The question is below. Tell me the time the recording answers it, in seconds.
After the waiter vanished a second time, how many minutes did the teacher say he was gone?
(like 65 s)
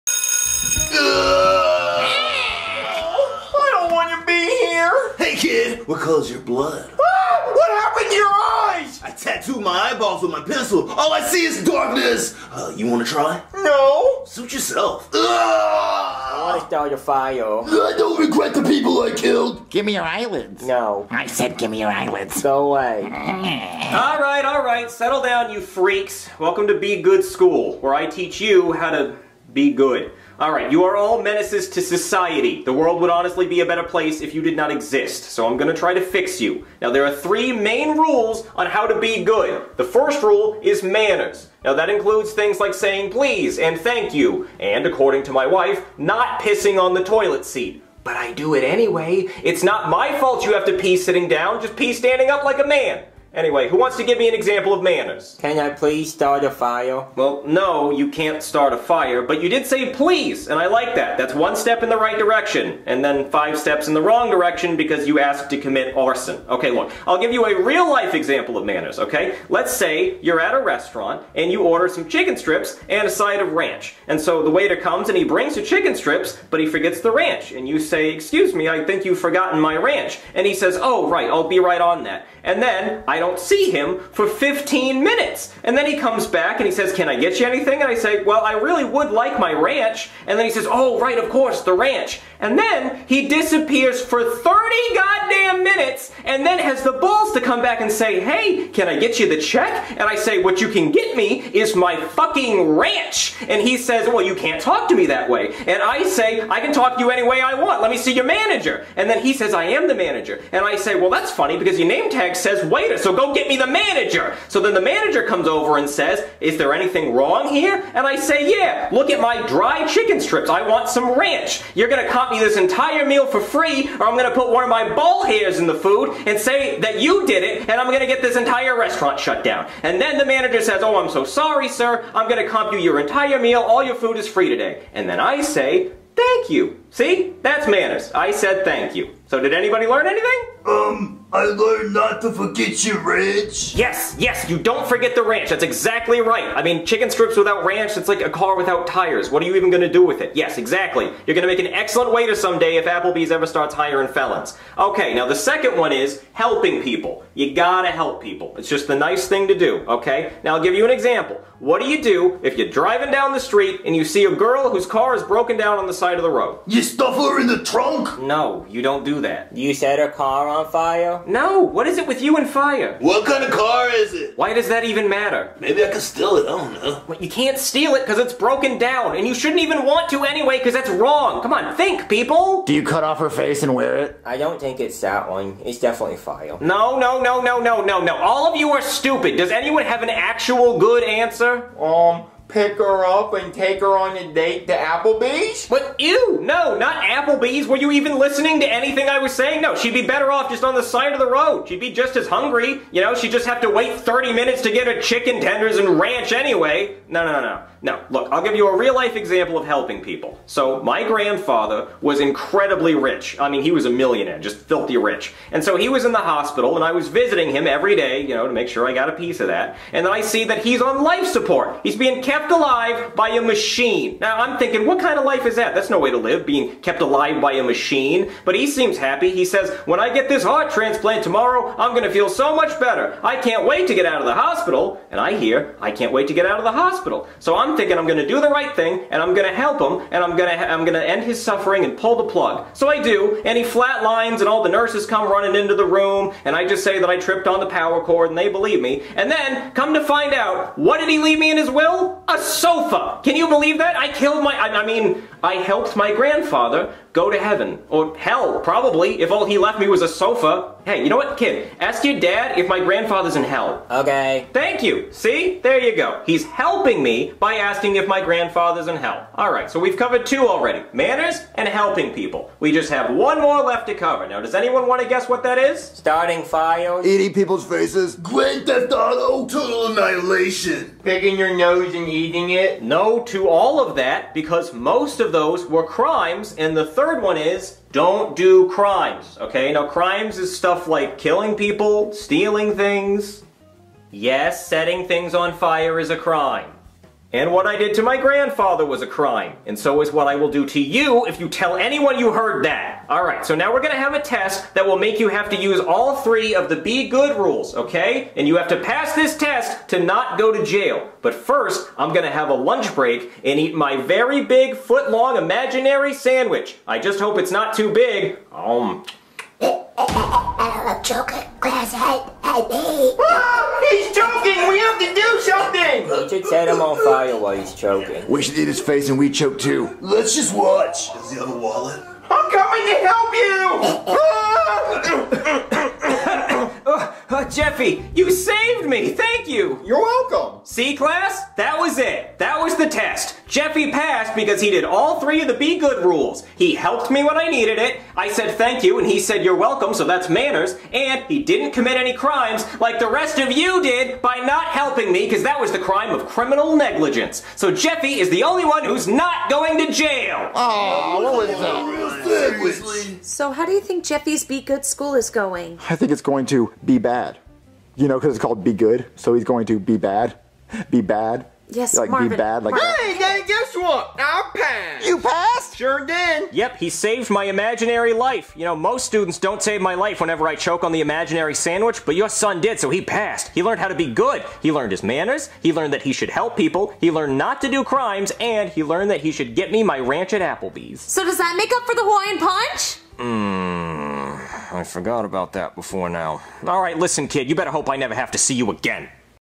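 94 s.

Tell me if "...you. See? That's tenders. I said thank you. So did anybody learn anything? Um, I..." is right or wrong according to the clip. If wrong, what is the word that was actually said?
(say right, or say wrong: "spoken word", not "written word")
wrong: "manners", not "tenders".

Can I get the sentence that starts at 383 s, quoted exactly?
He learned how to be good.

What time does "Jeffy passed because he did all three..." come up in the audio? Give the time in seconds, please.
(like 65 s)
343 s.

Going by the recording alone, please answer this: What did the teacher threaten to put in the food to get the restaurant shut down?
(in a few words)
one of my ball hairs.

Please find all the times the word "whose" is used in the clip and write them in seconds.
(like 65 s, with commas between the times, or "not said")
164 s.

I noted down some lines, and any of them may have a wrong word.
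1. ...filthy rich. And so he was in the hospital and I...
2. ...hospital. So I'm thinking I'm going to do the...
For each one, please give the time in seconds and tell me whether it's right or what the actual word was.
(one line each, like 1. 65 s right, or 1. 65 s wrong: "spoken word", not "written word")
1. 214 s right
2. 236 s right.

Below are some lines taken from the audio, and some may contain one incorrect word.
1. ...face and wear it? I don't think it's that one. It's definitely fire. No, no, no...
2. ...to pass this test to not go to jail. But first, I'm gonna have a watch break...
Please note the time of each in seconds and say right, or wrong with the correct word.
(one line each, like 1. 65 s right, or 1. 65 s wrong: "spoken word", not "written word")
1. 183 s right
2. 308 s wrong: "lunch", not "watch".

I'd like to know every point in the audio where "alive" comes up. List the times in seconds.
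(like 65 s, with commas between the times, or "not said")
222 s, 227 s.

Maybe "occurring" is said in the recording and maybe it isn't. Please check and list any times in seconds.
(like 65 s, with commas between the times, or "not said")
not said.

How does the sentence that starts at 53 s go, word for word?
Anyway, who wants to give me an example of manners?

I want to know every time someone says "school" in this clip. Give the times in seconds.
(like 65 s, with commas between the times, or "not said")
27 s, 364 s.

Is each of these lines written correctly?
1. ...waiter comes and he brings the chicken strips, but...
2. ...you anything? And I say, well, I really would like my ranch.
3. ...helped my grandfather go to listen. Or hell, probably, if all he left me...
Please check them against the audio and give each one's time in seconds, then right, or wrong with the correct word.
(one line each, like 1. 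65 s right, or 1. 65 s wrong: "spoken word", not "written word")
1. 74 s right
2. 87 s right
3. 255 s wrong: "heaven", not "listen".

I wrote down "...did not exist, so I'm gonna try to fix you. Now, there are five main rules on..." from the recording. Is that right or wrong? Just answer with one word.
wrong.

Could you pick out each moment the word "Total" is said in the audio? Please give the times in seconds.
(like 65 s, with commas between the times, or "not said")
279 s.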